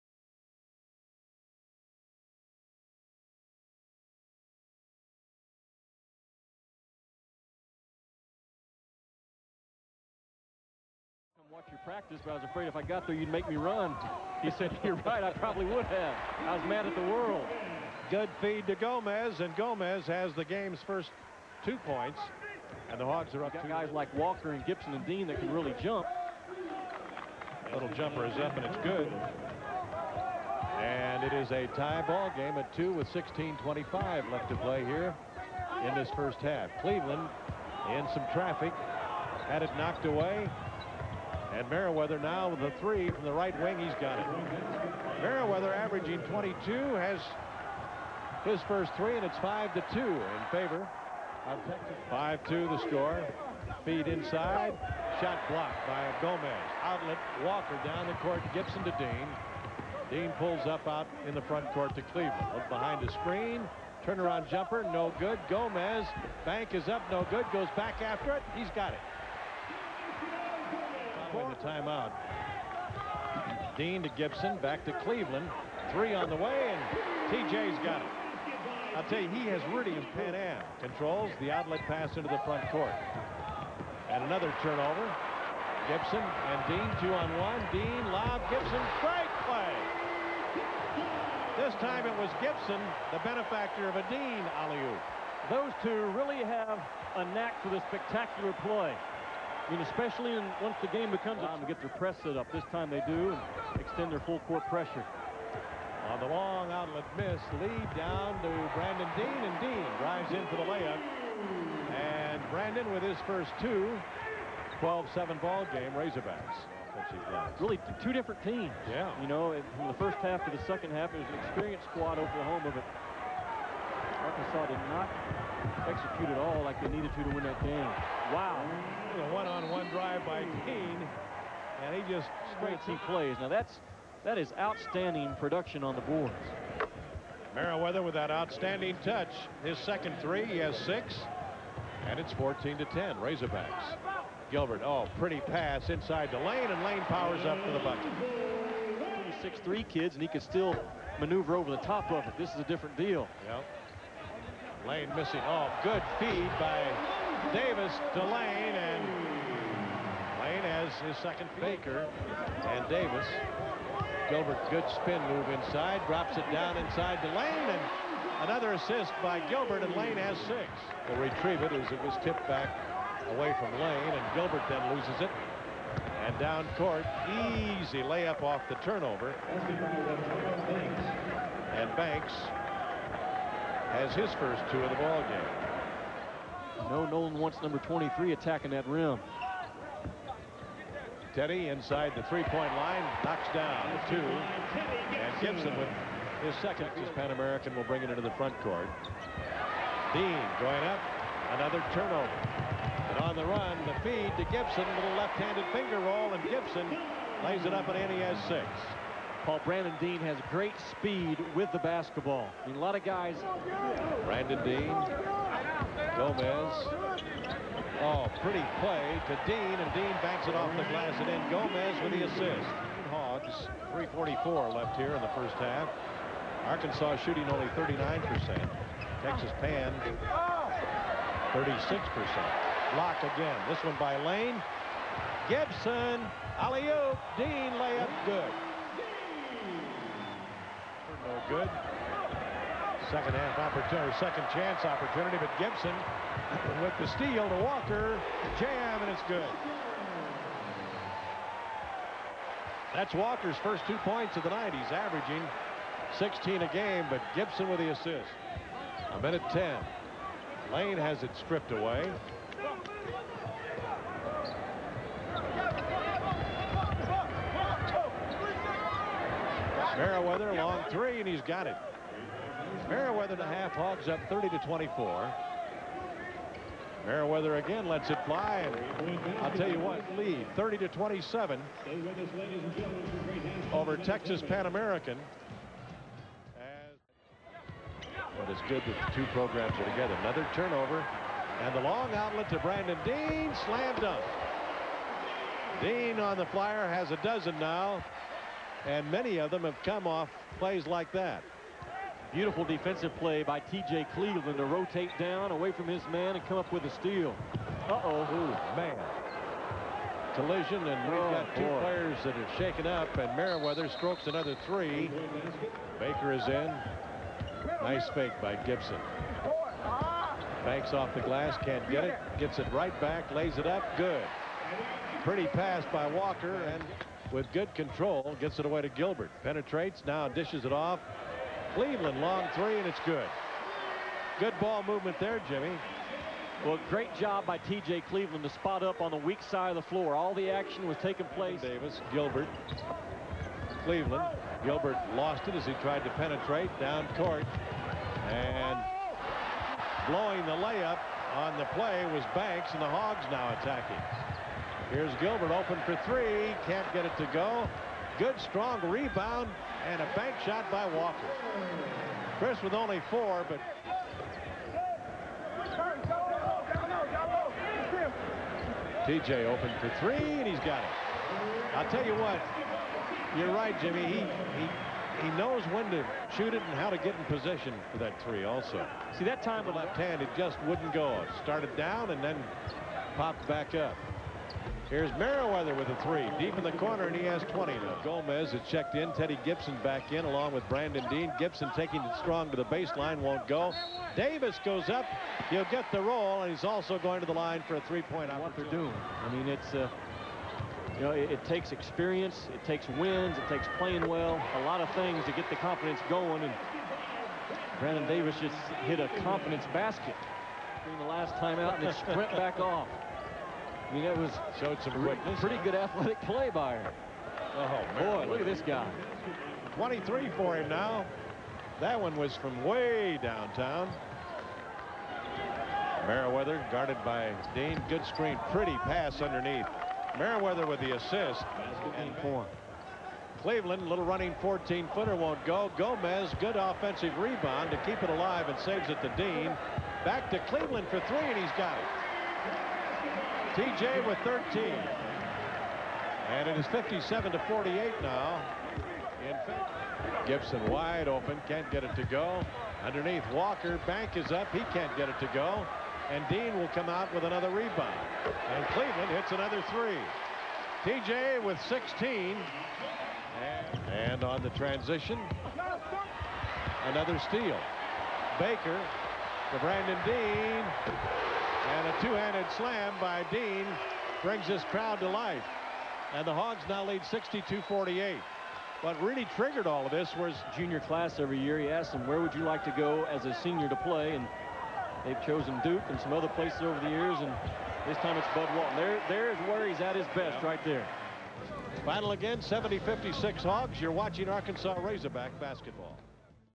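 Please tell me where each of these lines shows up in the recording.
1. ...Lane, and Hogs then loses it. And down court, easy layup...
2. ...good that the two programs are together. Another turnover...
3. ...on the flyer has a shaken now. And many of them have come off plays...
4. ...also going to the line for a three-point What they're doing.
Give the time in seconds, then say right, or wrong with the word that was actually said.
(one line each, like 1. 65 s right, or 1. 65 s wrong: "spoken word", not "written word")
1. 173 s wrong: "Gilbert", not "Hogs"
2. 288 s right
3. 296 s wrong: "dozen", not "shaken"
4. 396 s right.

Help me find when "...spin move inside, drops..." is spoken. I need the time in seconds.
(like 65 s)
165 s.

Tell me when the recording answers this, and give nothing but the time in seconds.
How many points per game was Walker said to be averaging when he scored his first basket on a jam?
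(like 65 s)
256 s.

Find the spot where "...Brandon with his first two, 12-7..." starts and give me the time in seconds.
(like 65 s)
112 s.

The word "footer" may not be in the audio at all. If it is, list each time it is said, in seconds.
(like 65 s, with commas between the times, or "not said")
434 s.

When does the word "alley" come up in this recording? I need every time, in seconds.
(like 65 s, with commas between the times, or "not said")
94 s, 236 s.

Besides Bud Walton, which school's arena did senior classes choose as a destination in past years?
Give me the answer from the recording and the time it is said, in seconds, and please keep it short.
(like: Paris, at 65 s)
Duke, at 485 s.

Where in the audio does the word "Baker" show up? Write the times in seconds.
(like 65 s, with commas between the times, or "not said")
161 s, 315 s, 468 s.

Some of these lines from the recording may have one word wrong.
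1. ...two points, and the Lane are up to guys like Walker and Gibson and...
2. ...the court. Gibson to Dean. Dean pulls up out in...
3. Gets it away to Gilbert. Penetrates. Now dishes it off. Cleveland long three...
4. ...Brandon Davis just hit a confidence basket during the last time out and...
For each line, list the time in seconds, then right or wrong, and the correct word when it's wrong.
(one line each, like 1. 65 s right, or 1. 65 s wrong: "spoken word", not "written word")
1. 21 s wrong: "Hogs", not "Lane"
2. 58 s right
3. 328 s right
4. 407 s right.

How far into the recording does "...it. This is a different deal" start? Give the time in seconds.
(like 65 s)
152 s.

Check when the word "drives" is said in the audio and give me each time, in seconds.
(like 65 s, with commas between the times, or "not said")
110 s, 129 s.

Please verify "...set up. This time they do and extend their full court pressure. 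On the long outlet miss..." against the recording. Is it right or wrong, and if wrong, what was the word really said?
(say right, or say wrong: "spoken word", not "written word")
right.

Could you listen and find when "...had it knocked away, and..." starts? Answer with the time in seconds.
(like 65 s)
39 s.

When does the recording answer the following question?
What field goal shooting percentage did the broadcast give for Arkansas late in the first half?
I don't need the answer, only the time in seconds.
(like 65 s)
227 s.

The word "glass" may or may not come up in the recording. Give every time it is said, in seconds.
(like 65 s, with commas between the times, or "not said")
220 s, 321 s.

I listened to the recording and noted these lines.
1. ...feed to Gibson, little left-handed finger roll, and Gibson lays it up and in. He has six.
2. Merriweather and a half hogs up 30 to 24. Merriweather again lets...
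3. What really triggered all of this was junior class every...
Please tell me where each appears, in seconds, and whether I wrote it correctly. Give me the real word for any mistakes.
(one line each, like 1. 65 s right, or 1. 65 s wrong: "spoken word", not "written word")
1. 204 s right
2. 272 s right
3. 478 s right.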